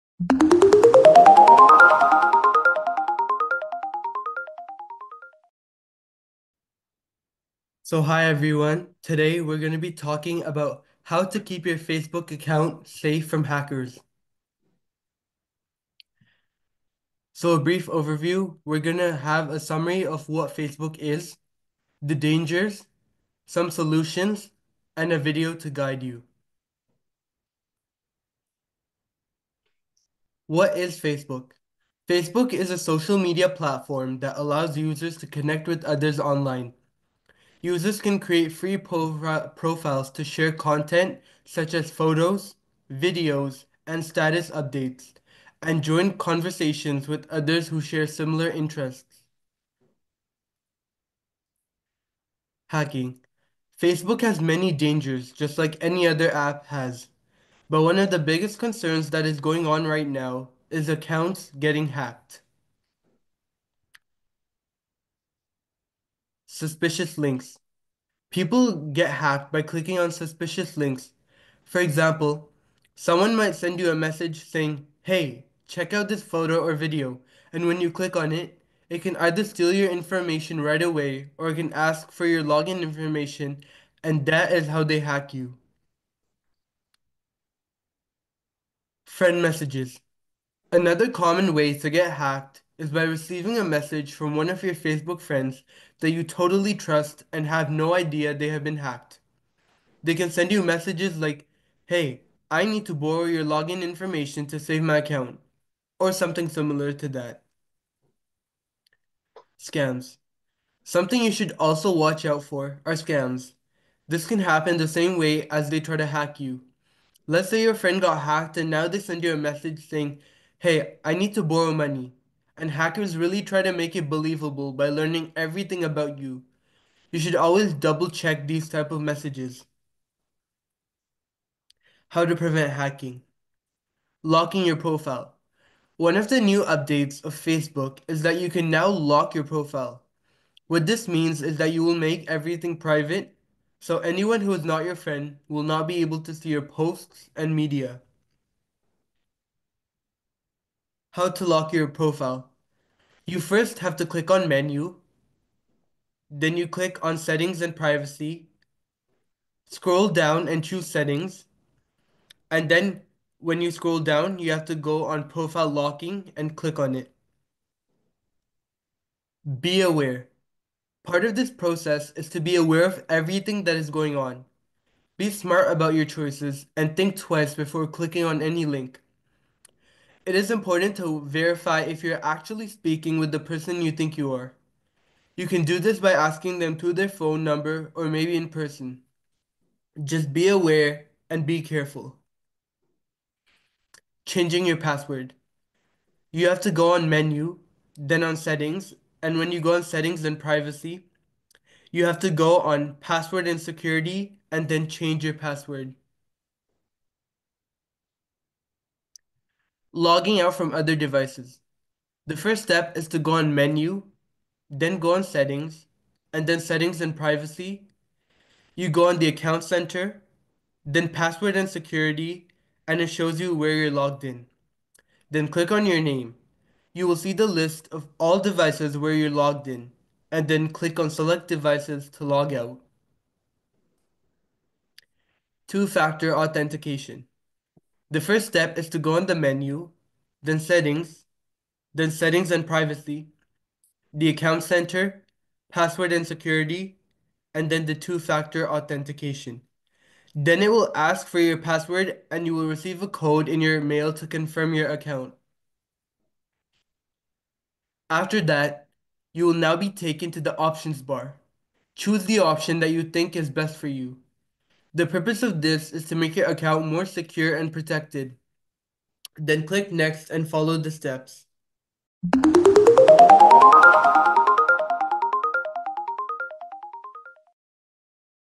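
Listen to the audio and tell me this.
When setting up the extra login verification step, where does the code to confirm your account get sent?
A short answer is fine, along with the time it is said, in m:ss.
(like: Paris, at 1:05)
Your mail, at 4:13.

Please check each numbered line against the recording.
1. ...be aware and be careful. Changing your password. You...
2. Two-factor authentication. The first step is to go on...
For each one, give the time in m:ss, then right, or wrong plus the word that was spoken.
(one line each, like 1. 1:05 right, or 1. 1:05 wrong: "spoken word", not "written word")
1. 3:10 right
2. 3:55 right.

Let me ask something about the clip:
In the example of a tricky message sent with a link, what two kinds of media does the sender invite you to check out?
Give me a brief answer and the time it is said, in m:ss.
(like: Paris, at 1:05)
Photo or video, at 1:16.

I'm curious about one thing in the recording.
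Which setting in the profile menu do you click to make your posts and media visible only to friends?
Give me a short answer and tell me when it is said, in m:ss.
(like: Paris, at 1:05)
Profile locking, at 2:45.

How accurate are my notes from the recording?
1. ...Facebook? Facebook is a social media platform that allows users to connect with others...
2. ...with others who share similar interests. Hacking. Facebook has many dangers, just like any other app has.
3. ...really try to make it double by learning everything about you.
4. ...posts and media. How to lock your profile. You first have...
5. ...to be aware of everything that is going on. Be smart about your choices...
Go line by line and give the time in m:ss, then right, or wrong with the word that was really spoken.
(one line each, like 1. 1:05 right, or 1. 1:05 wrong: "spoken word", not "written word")
1. 0:30 right
2. 0:47 right
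3. 2:03 wrong: "believable", not "double"
4. 2:26 right
5. 2:52 right.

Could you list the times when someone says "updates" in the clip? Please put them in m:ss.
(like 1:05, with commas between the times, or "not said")
0:44, 2:16.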